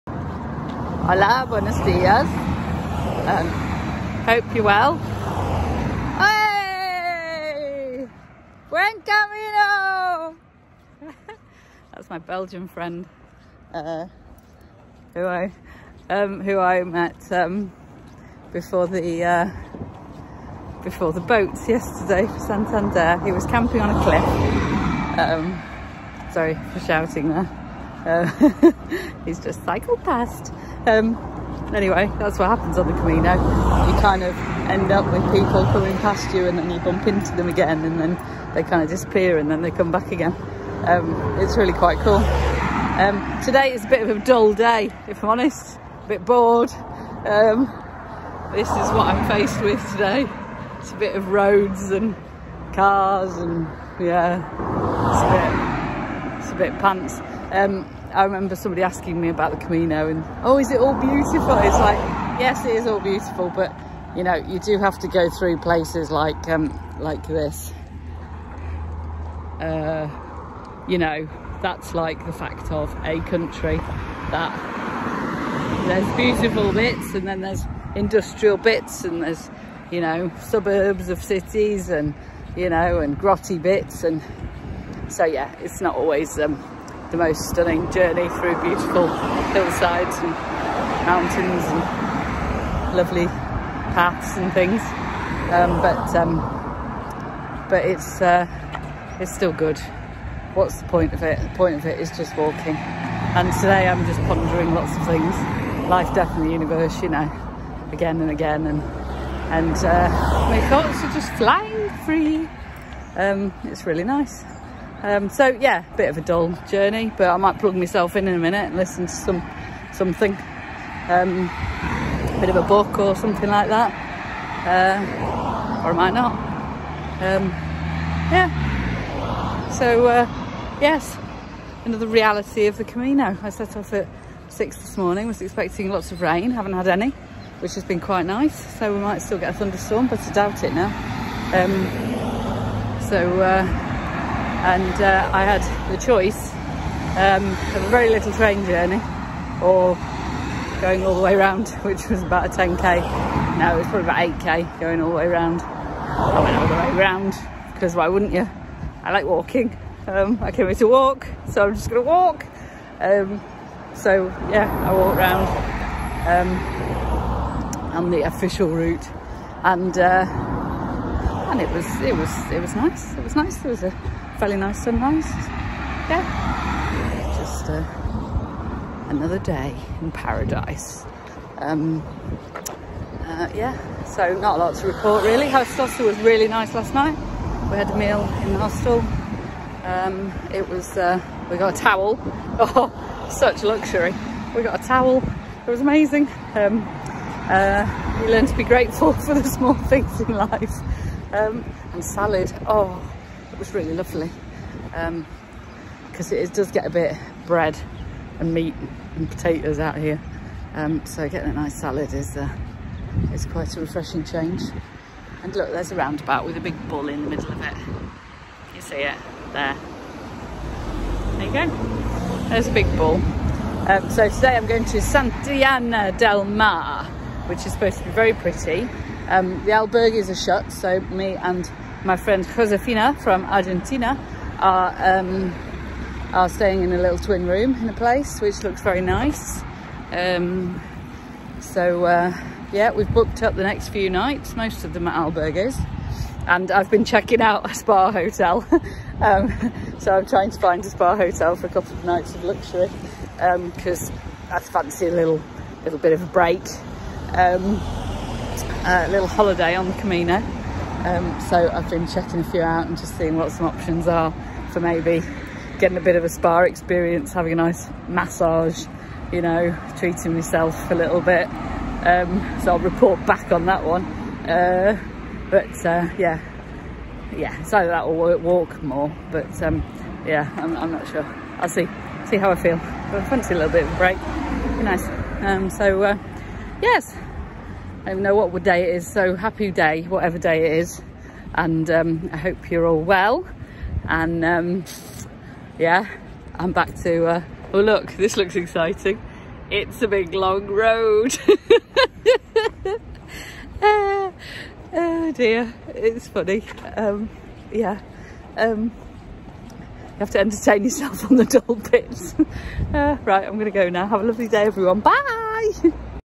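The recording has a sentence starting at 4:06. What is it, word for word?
And I've been checking out a spa hotel.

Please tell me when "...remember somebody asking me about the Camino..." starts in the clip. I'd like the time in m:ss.
0:58.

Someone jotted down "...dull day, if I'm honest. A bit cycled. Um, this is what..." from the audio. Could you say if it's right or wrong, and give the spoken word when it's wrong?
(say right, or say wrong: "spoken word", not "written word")
wrong: "bored", not "cycled".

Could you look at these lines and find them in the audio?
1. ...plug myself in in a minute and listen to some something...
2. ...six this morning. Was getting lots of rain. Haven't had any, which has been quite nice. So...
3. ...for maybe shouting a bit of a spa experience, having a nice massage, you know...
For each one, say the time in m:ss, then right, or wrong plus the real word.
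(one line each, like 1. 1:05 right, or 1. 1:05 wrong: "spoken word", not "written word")
1. 1:57 right
2. 2:14 wrong: "expecting", not "getting"
3. 4:24 wrong: "getting", not "shouting".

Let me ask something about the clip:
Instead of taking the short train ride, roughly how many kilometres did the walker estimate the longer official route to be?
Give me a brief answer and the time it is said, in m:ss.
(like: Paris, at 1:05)
8k, at 2:34.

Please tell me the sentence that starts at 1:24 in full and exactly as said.
And so, yeah, it's not always, um, the most stunning journey through beautiful hillsides and mountains and lovely paths and things.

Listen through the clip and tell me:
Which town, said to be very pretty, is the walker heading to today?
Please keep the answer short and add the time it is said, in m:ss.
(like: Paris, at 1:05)
Santillana del Mar, at 3:44.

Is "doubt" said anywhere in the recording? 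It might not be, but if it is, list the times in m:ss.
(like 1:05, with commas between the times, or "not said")
2:20.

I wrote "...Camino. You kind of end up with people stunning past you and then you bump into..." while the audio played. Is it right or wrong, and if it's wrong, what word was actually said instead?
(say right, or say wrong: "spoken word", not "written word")
wrong: "coming", not "stunning".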